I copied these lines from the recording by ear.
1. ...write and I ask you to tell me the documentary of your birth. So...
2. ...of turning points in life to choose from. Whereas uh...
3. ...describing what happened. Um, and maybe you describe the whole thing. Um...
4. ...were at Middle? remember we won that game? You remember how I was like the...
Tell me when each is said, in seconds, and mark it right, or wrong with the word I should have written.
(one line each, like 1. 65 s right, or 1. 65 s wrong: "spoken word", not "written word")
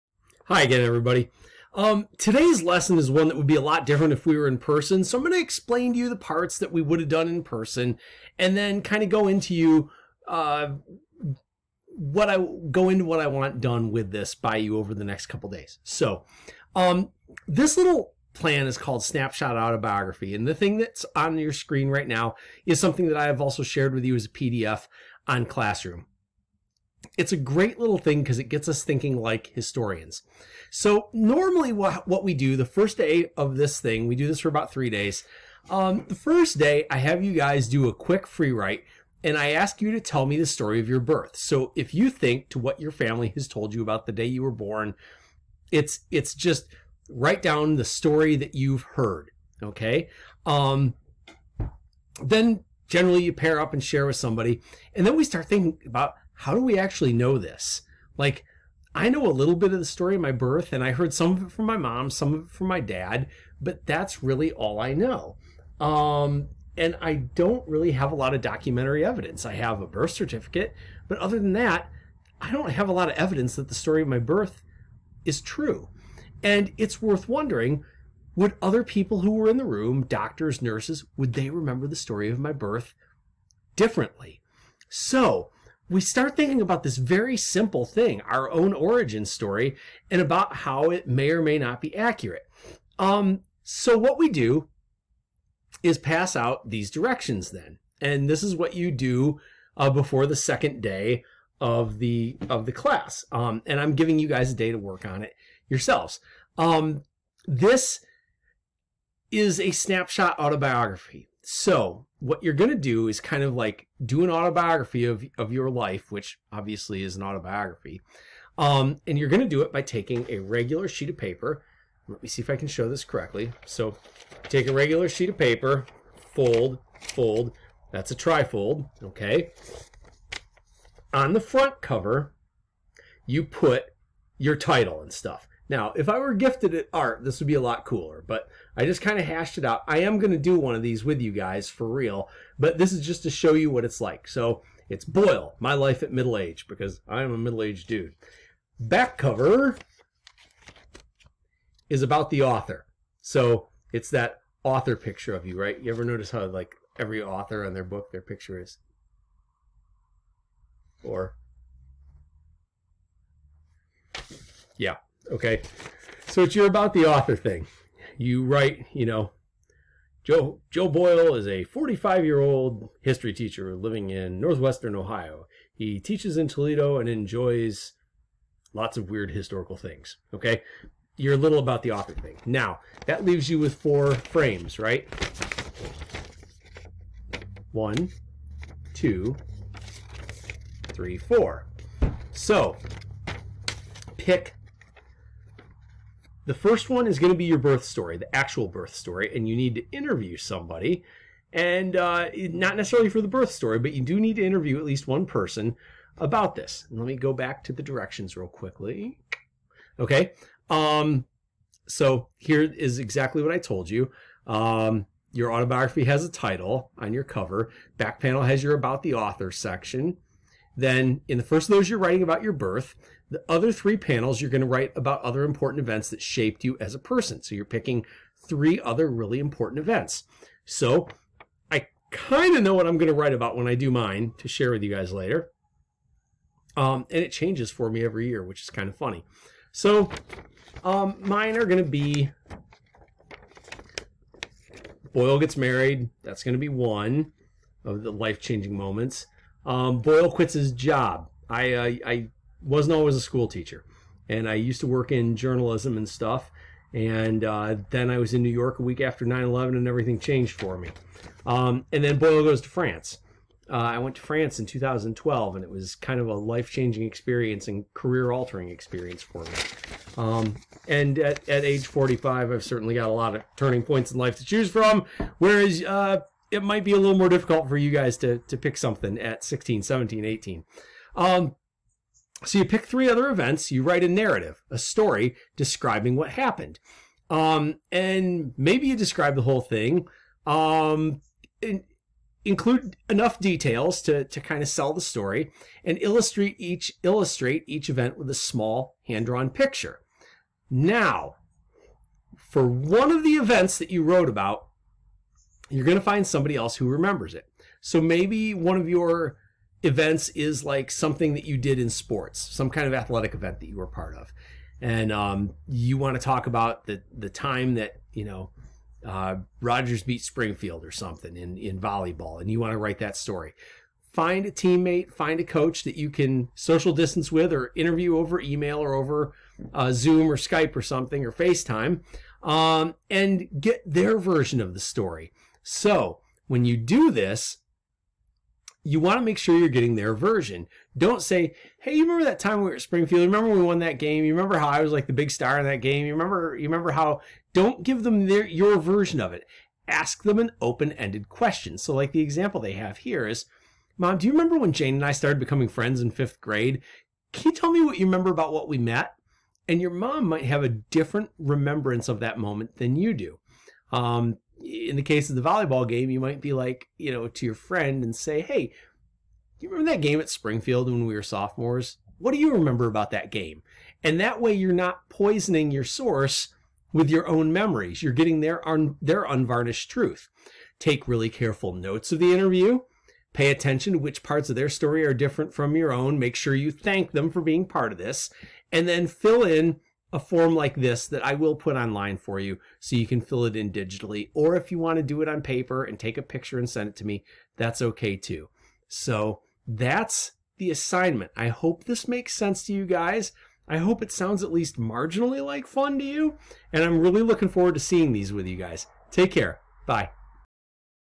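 1. 38 s wrong: "story", not "documentary"
2. 273 s right
3. 285 s right
4. 342 s wrong: "Springfield", not "Middle".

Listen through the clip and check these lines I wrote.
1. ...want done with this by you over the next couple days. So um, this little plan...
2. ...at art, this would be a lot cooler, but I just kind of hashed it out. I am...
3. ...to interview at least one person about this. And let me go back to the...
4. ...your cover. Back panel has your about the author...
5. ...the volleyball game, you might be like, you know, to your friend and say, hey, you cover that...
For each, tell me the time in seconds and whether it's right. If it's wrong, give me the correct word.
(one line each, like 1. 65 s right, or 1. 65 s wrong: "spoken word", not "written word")
1. 13 s right
2. 136 s right
3. 204 s right
4. 217 s right
5. 365 s wrong: "remember", not "cover".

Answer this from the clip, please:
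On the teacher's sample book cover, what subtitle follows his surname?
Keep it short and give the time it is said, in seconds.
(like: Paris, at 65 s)
My Life at Middle Age, at 145 s.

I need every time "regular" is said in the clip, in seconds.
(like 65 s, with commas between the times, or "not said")
120 s, 124 s.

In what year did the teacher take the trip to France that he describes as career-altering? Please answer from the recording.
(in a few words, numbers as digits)
2012.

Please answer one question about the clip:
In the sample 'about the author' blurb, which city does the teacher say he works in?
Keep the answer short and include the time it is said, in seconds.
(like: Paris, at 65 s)
Toledo, at 176 s.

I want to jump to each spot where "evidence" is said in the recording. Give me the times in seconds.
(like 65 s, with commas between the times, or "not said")
69 s, 73 s.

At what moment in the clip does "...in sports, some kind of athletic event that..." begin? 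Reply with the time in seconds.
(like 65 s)
311 s.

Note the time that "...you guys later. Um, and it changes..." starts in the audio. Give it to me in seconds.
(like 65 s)
234 s.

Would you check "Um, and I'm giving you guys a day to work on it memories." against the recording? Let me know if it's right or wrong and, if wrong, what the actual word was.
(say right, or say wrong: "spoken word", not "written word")
wrong: "yourselves", not "memories".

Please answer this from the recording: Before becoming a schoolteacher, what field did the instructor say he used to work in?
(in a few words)
Journalism.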